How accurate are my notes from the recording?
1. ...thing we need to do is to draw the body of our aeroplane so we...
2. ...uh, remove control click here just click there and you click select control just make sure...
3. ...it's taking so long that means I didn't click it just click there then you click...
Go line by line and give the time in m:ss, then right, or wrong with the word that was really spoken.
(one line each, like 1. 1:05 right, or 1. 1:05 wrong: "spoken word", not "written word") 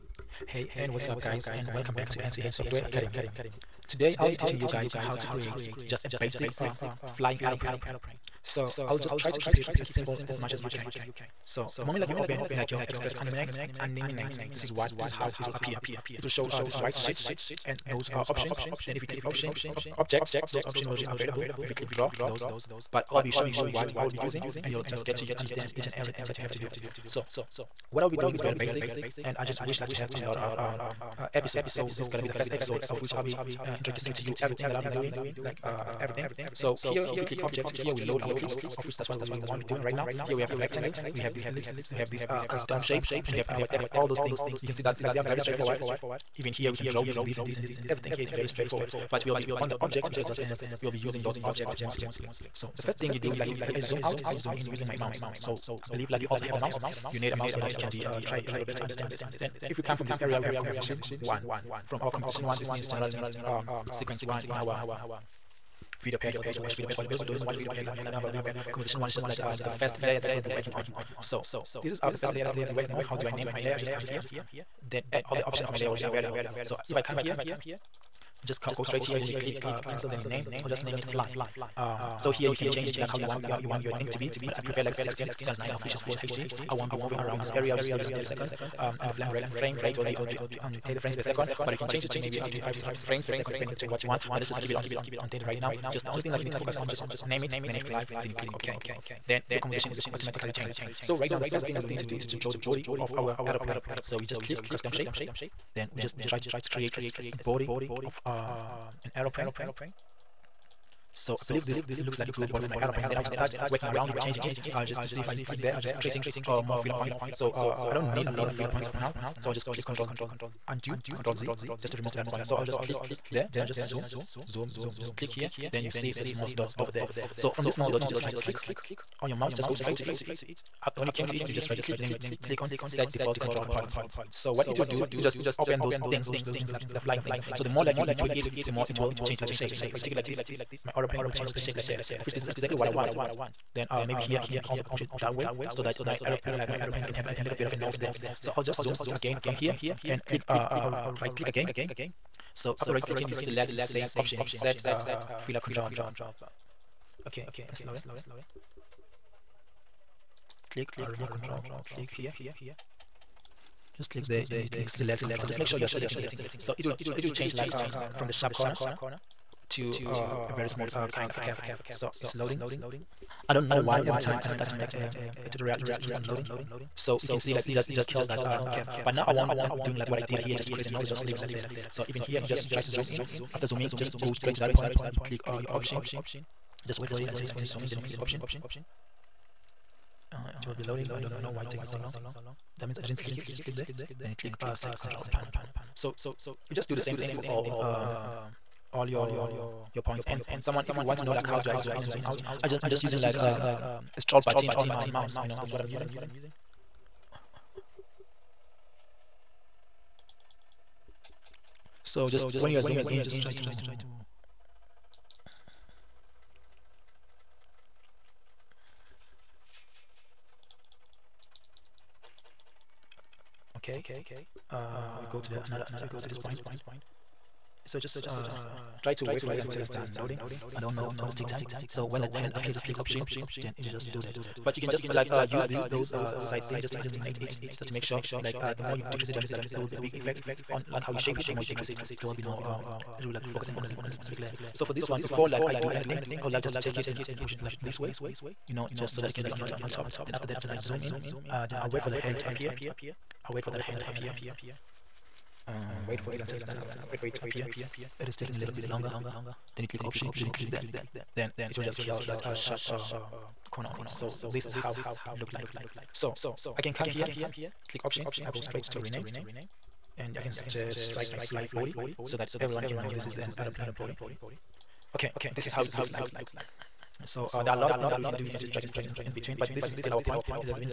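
1. 1:41 right
2. 2:40 right
3. 3:11 right.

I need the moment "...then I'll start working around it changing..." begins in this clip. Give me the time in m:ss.
1:53.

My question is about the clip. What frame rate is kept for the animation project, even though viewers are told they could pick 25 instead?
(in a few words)
30 frames per second.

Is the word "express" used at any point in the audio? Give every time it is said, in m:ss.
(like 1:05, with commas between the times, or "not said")
0:12.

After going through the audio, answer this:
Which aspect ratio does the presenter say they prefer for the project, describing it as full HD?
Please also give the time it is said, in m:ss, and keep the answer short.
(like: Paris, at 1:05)
16 by 9, at 1:24.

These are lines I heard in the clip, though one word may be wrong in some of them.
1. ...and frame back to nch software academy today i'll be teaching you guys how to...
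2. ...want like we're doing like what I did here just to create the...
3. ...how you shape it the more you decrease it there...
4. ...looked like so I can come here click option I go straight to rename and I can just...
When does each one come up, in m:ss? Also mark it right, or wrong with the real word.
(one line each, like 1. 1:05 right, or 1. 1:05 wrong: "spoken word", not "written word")
1. 0:01 wrong: "welcome", not "frame"
2. 2:59 right
3. 4:01 right
4. 4:25 right.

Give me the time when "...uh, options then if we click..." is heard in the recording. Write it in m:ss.
0:18.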